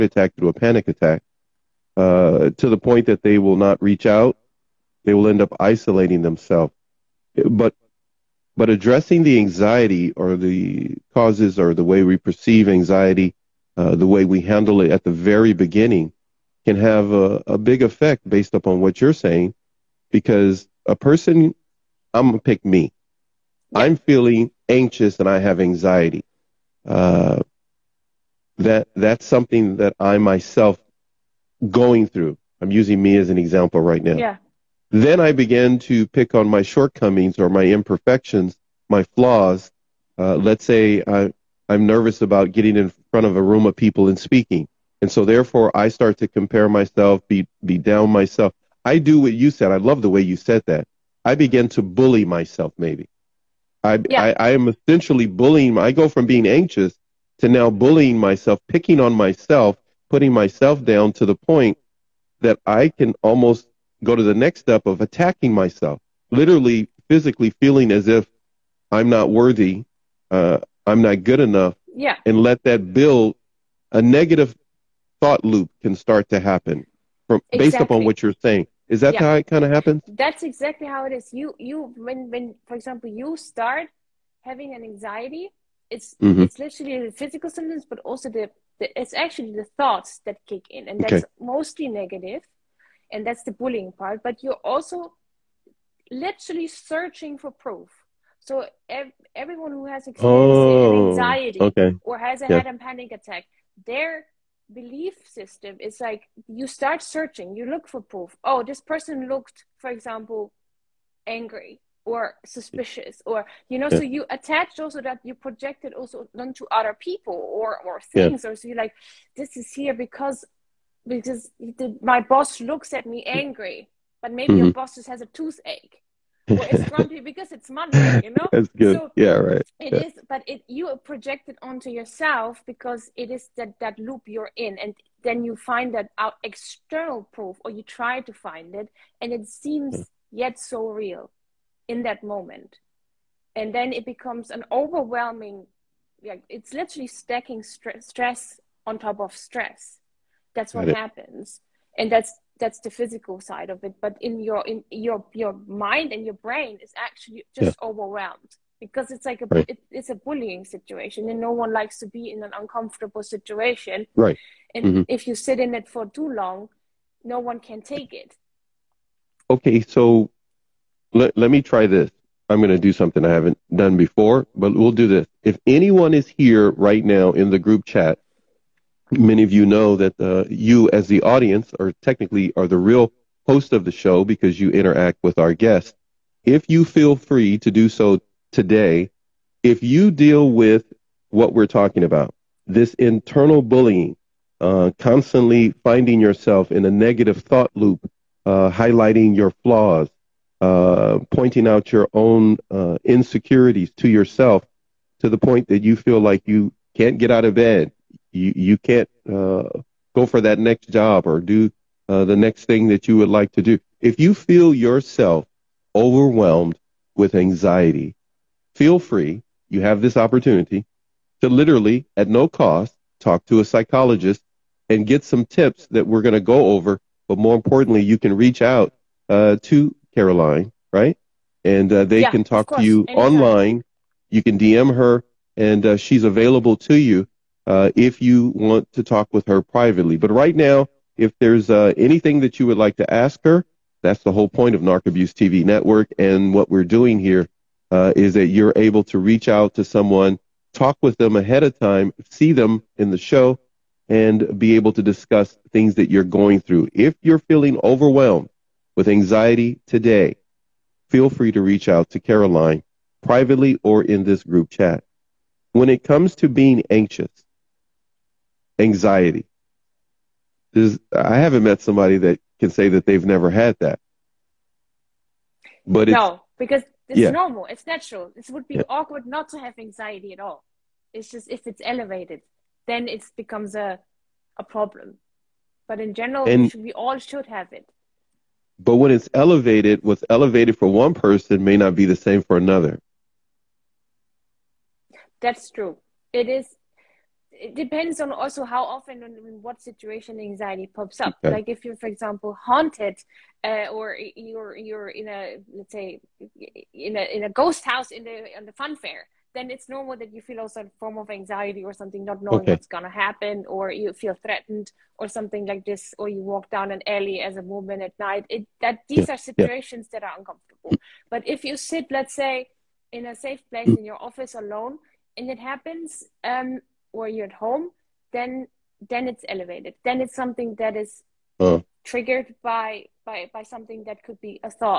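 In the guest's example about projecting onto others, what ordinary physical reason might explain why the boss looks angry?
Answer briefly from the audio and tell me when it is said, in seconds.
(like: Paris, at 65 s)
a toothache, at 125 s.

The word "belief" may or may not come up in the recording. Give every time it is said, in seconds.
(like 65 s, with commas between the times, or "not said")
104 s.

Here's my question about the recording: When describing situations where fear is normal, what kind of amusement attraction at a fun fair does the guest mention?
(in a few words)
ghost house.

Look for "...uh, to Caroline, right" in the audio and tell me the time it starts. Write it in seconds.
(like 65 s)
229 s.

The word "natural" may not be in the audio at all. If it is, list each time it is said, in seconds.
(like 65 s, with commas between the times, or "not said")
277 s.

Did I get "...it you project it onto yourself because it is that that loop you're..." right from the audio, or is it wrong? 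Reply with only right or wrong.
right.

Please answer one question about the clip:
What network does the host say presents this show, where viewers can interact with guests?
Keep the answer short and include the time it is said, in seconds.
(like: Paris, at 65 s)
Narc Abuse TV Network, at 244 s.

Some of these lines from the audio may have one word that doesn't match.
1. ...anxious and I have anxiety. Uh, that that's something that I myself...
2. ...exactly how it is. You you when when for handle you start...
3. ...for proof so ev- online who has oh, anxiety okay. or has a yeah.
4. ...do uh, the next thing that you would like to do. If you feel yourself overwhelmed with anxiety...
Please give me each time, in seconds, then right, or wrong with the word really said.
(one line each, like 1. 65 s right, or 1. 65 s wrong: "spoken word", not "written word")
1. 24 s right
2. 80 s wrong: "example", not "handle"
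3. 97 s wrong: "everyone", not "online"
4. 211 s right.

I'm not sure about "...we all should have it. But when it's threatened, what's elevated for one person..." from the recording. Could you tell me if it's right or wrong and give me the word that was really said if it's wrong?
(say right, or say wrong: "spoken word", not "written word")
wrong: "elevated", not "threatened".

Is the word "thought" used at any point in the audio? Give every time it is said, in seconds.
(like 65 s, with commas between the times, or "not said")
75 s, 89 s, 197 s.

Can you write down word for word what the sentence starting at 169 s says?
Okay, so let let me try this.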